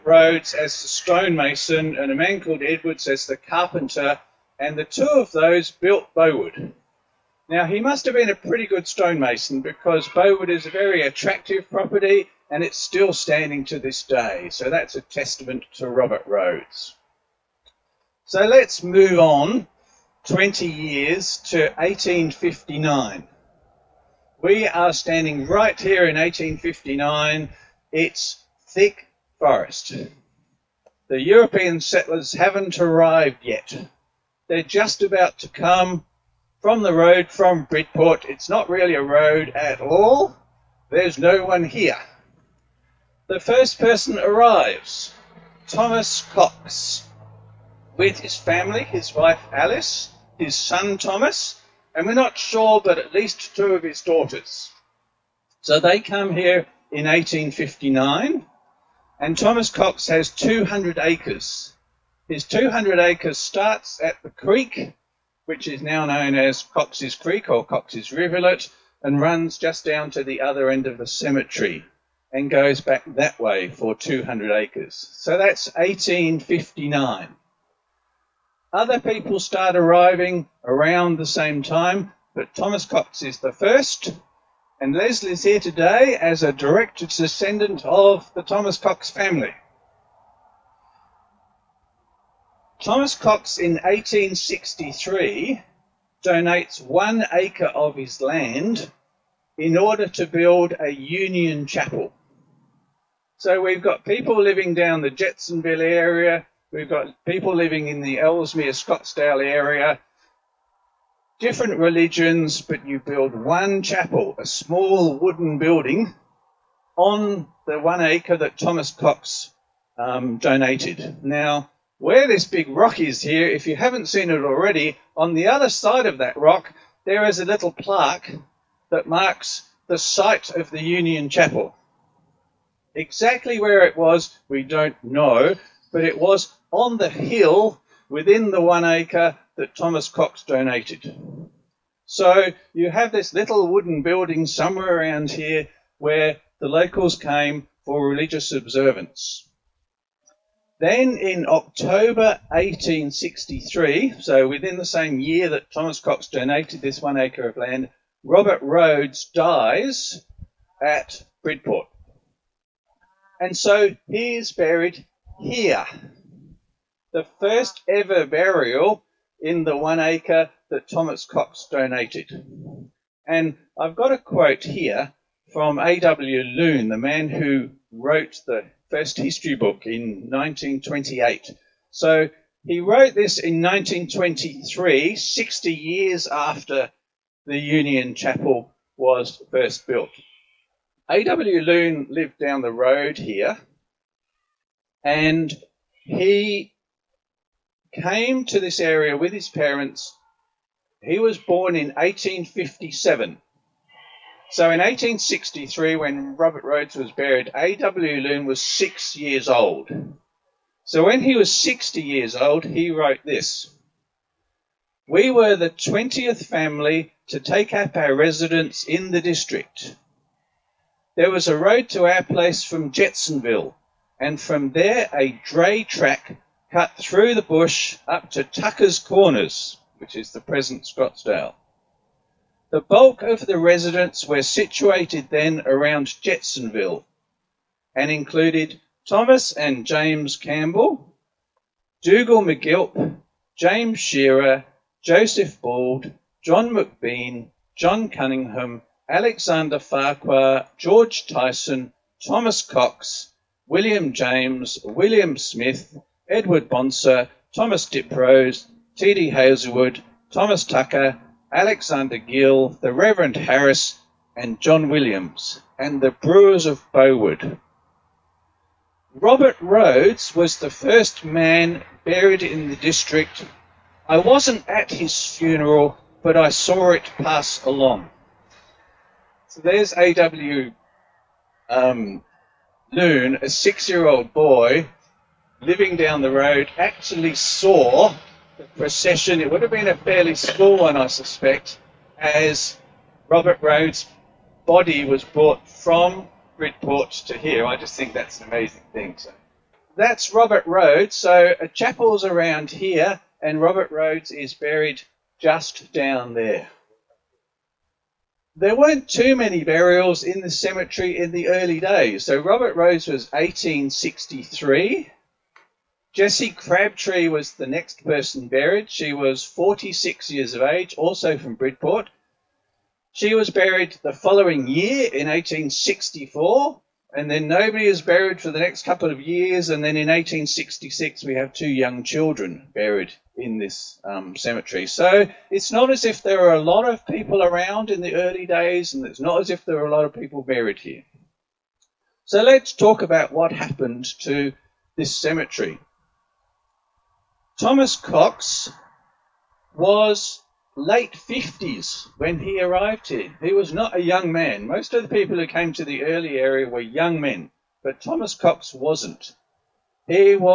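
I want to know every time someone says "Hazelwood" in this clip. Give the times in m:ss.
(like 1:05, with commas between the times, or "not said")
4:19.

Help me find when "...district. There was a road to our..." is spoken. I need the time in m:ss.
3:39.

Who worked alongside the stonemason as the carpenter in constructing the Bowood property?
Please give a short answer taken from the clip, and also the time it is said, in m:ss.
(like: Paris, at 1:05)
Edwards, at 0:02.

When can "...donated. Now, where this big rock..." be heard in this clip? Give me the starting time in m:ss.
2:00.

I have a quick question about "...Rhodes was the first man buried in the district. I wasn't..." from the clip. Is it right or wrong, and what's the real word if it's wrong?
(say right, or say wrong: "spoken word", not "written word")
right.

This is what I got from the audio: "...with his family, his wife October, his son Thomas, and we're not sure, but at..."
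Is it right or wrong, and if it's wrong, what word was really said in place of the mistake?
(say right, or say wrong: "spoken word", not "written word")
wrong: "Alice", not "October".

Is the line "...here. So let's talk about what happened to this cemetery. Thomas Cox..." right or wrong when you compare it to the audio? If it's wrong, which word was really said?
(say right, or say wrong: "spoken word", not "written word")
right.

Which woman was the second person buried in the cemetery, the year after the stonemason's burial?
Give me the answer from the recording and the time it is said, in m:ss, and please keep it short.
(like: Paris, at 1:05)
Jessie Crabtree, at 5:16.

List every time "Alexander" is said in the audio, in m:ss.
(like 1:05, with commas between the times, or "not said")
4:09, 4:21.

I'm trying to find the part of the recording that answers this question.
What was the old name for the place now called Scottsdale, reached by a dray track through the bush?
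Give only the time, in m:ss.
3:48.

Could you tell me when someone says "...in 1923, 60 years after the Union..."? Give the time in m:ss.
3:03.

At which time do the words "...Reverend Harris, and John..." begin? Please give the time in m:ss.
4:22.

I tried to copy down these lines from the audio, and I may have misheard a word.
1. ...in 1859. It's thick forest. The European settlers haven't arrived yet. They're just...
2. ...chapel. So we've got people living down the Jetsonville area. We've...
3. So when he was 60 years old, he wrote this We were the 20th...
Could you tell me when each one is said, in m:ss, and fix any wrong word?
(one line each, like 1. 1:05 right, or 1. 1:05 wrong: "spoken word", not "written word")
1. 0:26 right
2. 1:41 right
3. 3:30 right.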